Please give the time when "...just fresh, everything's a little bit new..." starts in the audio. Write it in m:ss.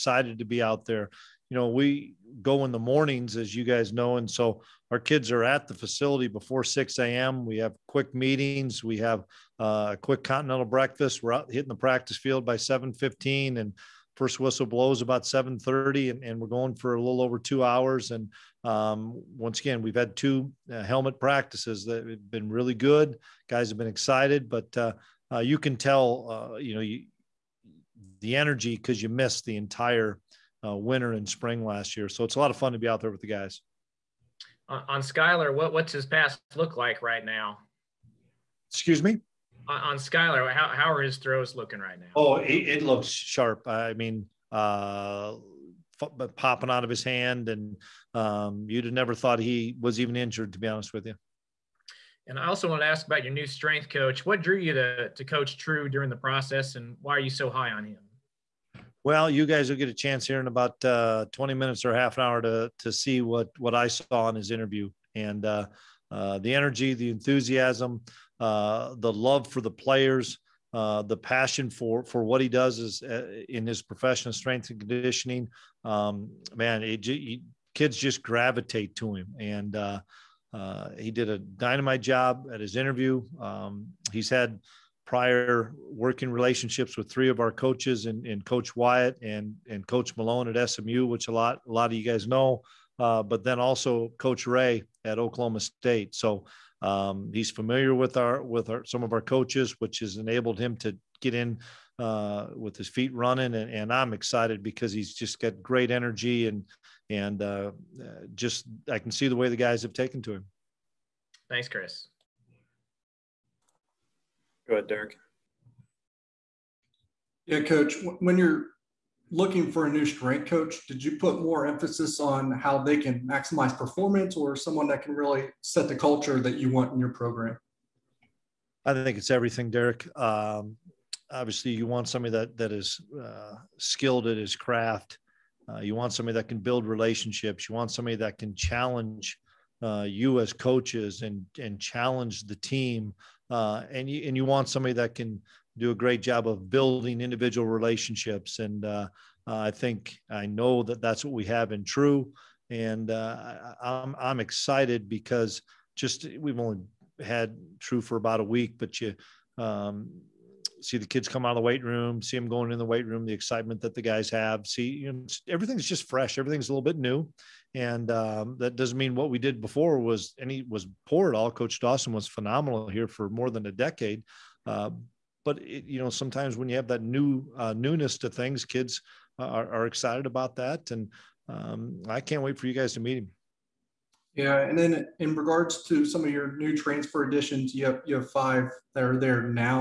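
2:45.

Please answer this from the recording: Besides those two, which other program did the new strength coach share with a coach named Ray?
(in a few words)
Oklahoma State.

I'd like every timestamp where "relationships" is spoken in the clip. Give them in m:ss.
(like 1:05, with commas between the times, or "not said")
1:26, 2:16, 2:27.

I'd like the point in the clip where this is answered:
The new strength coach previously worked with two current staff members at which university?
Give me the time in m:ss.
1:30.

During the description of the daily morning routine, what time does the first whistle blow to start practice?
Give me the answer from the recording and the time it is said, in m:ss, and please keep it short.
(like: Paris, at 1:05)
7:30, at 0:15.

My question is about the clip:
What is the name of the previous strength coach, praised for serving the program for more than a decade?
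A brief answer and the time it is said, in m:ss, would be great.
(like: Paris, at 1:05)
Coach Dawson, at 2:51.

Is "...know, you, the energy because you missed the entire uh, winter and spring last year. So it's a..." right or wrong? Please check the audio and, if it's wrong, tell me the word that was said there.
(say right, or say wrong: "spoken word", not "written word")
right.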